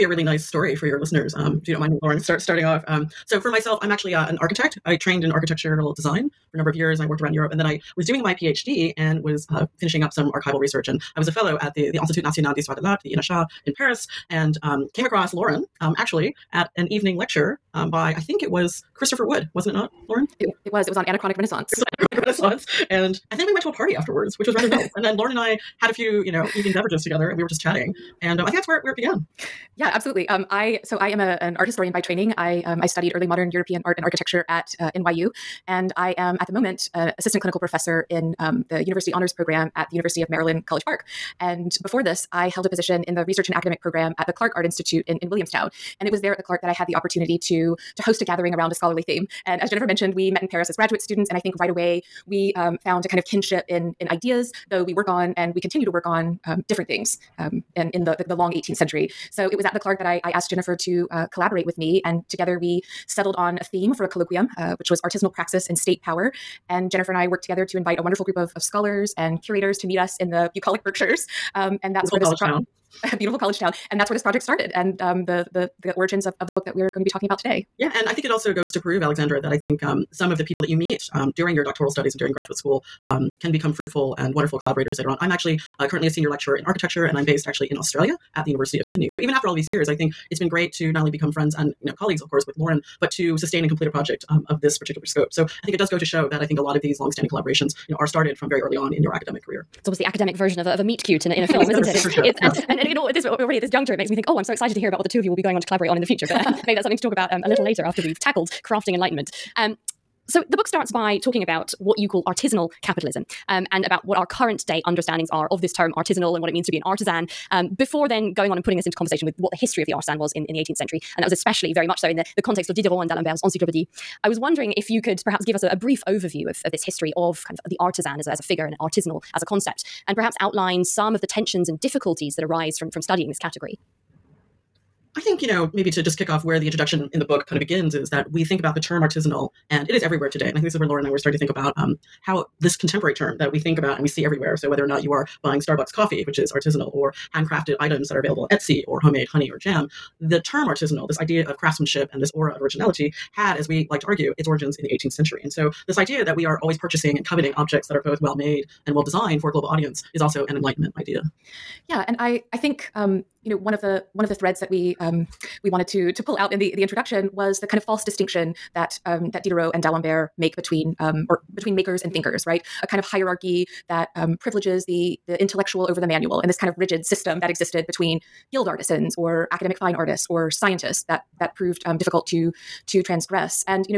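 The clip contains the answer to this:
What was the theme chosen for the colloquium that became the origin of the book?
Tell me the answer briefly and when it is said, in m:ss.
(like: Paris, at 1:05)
Artisanal praxis and state power, at 1:05.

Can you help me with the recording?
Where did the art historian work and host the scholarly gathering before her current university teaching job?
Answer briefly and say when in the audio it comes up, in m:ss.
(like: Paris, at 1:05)
Clark Art Institute, at 0:44.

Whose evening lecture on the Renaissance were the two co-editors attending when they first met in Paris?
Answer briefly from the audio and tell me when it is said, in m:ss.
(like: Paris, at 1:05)
Christopher Wood, at 0:18.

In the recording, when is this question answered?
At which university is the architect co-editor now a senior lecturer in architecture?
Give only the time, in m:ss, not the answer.
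1:28.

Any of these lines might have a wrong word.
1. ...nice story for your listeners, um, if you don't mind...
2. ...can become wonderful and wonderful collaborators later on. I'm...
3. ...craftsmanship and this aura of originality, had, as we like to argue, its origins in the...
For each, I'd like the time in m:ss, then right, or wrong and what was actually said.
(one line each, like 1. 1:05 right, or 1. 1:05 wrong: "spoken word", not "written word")
1. 0:00 right
2. 1:23 wrong: "fruitful", not "wonderful"
3. 2:31 right.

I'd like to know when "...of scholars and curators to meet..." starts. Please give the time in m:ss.
1:08.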